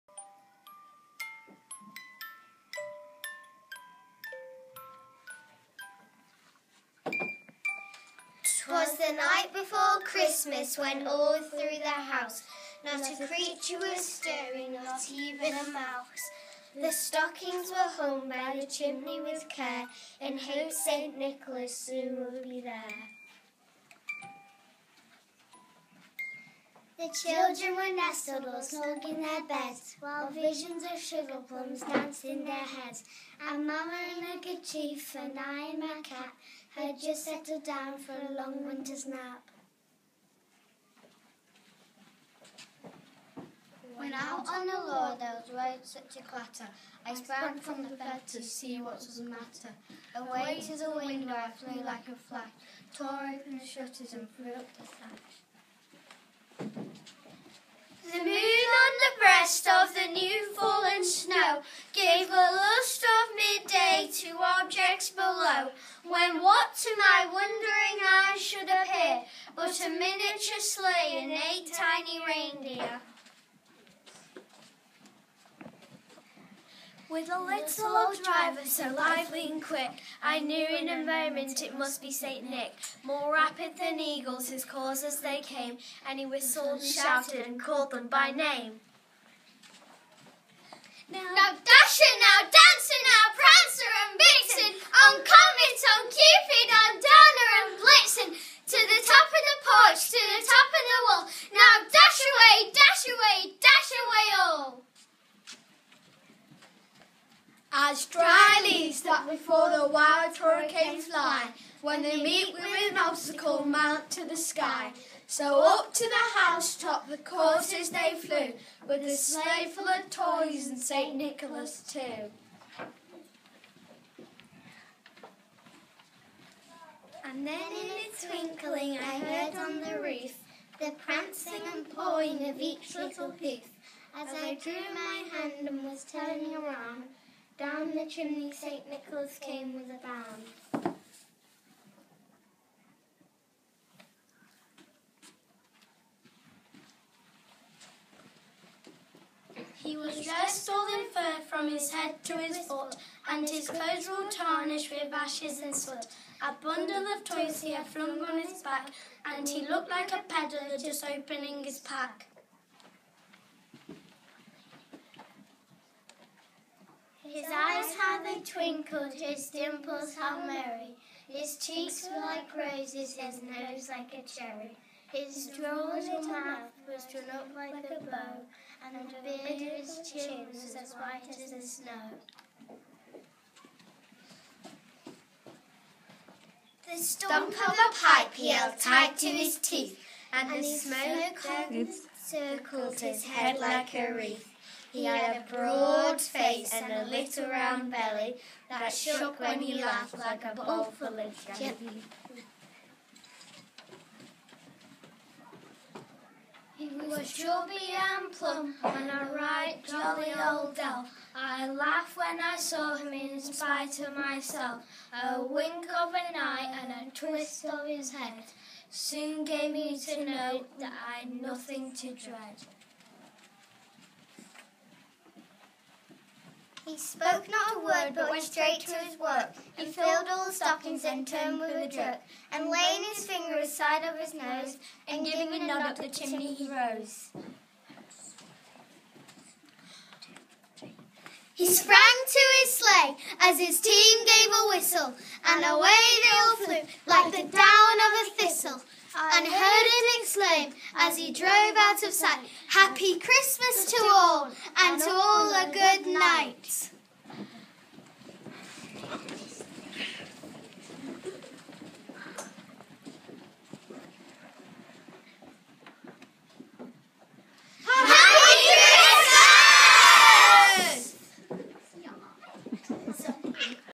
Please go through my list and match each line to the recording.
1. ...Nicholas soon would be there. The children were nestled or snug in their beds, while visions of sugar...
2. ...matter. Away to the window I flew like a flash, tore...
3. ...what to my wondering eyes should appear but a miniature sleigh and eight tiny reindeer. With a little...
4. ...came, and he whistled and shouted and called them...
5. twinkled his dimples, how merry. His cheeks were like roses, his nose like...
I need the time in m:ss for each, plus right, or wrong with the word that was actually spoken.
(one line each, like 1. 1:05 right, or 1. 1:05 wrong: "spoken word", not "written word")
1. 0:21 right
2. 0:49 right
3. 1:06 right
4. 1:25 right
5. 2:48 right.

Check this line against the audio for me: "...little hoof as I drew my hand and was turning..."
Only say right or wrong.
right.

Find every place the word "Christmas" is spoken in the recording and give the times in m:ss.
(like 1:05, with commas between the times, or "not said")
0:10, 4:13.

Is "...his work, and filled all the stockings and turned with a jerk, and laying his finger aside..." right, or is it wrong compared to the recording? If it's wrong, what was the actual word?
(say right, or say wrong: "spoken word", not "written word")
right.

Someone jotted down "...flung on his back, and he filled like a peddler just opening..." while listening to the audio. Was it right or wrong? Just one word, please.
wrong.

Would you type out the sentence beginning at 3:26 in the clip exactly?
He was chubby and plump and a right jolly old elf.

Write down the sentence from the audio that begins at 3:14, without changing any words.
He had a broad face and a little round belly that shook when he laughed like a bowl full of jelly.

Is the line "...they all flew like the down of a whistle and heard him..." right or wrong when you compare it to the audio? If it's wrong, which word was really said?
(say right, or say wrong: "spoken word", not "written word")
wrong: "thistle", not "whistle".